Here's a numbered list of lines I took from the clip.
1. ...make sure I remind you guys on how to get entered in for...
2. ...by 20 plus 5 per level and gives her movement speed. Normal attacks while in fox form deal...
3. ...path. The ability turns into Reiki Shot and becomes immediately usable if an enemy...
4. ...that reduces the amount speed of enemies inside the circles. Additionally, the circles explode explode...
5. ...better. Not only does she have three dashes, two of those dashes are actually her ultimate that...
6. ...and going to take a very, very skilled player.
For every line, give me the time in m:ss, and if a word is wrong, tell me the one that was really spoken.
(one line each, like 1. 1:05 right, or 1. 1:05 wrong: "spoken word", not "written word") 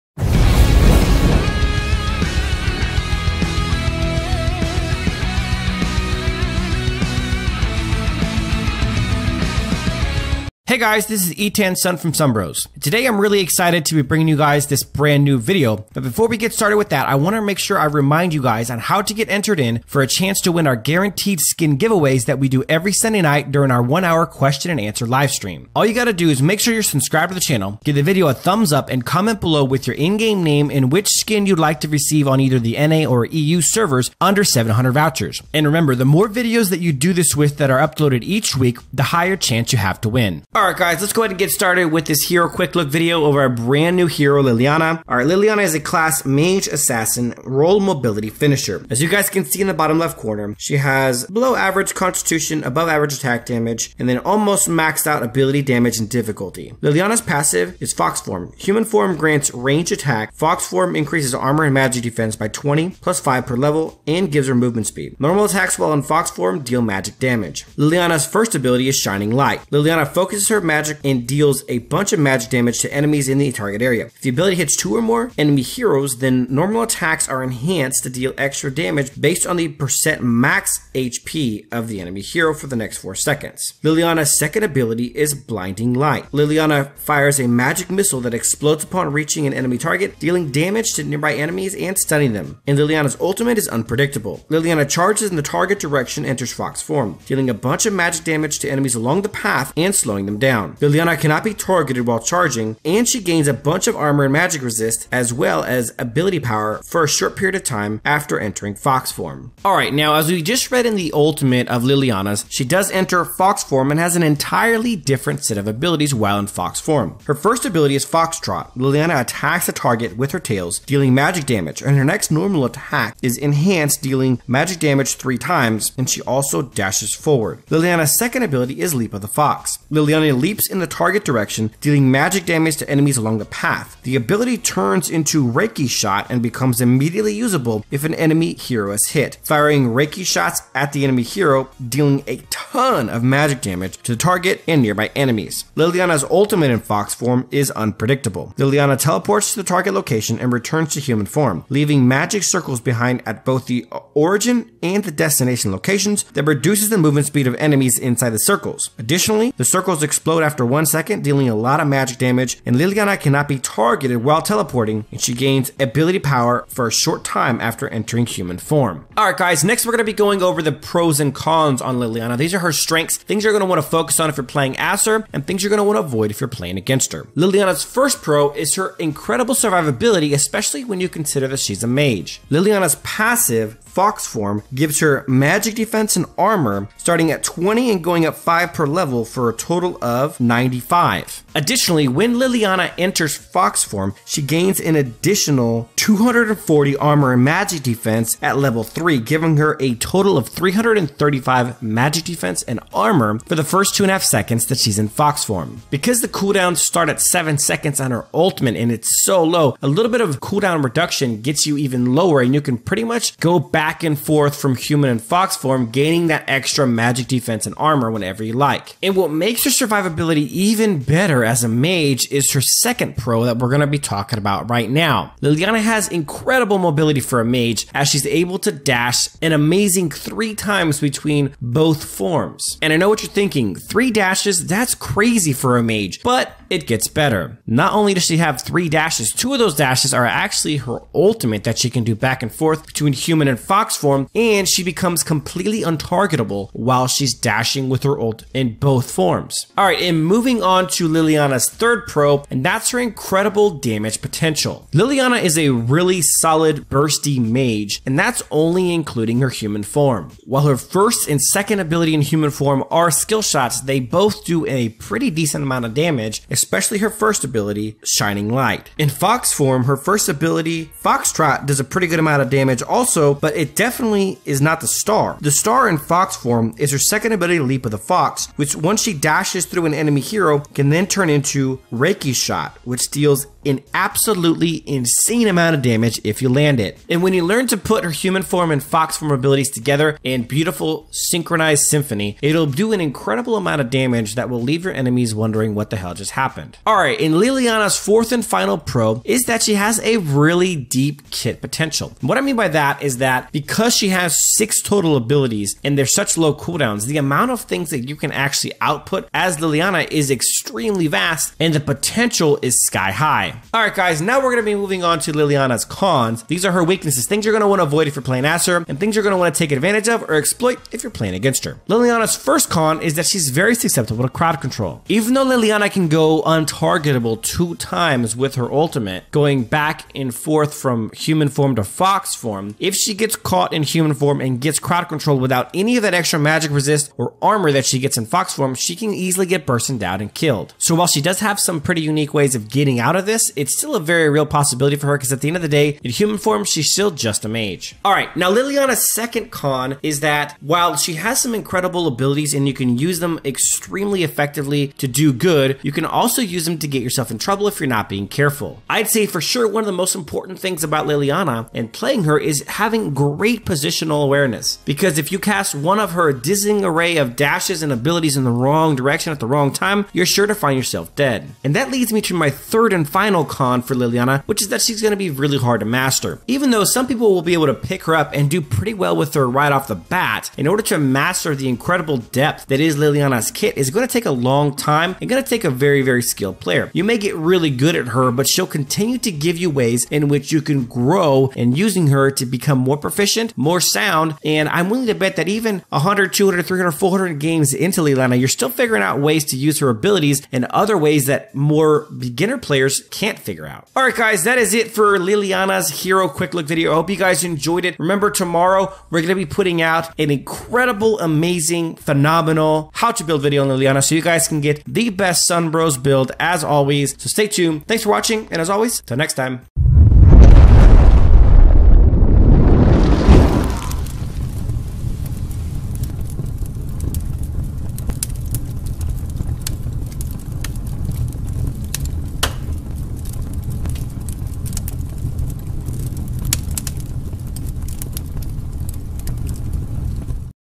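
1. 0:17 right
2. 1:02 right
3. 2:13 right
4. 2:36 wrong: "movement", not "amount"
5. 3:57 right
6. 6:25 right.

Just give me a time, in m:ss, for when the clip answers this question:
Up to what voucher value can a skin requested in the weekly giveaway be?
0:34.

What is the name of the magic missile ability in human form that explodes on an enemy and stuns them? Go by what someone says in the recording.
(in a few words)
Blinding Light.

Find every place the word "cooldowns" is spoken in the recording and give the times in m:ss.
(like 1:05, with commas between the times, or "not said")
3:26, 3:30, 5:06.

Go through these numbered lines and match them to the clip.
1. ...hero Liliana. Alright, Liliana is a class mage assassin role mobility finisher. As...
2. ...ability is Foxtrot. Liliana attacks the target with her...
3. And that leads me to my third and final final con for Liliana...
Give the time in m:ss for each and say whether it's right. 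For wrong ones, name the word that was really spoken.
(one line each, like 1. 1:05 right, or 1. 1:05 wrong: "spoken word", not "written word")
1. 0:44 right
2. 1:57 right
3. 6:11 right.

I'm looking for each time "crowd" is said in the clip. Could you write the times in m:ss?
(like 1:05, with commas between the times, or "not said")
5:24, 5:34.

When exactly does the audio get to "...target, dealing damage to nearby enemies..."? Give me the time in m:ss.
1:29.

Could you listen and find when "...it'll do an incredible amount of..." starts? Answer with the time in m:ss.
4:52.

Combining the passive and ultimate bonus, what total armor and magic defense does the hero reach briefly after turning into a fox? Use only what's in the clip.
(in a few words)
335.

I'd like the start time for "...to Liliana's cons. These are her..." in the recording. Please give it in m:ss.
5:15.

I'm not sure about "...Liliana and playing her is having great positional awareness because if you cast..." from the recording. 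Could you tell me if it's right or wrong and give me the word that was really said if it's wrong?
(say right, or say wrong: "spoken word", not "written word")
right.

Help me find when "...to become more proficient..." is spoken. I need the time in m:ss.
6:32.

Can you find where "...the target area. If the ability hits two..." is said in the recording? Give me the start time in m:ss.
1:13.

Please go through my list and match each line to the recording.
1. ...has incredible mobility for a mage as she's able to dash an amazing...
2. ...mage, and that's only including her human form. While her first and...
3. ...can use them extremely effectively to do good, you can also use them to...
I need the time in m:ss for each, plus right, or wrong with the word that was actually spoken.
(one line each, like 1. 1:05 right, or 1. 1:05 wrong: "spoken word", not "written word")
1. 3:45 right
2. 4:17 right
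3. 5:52 right.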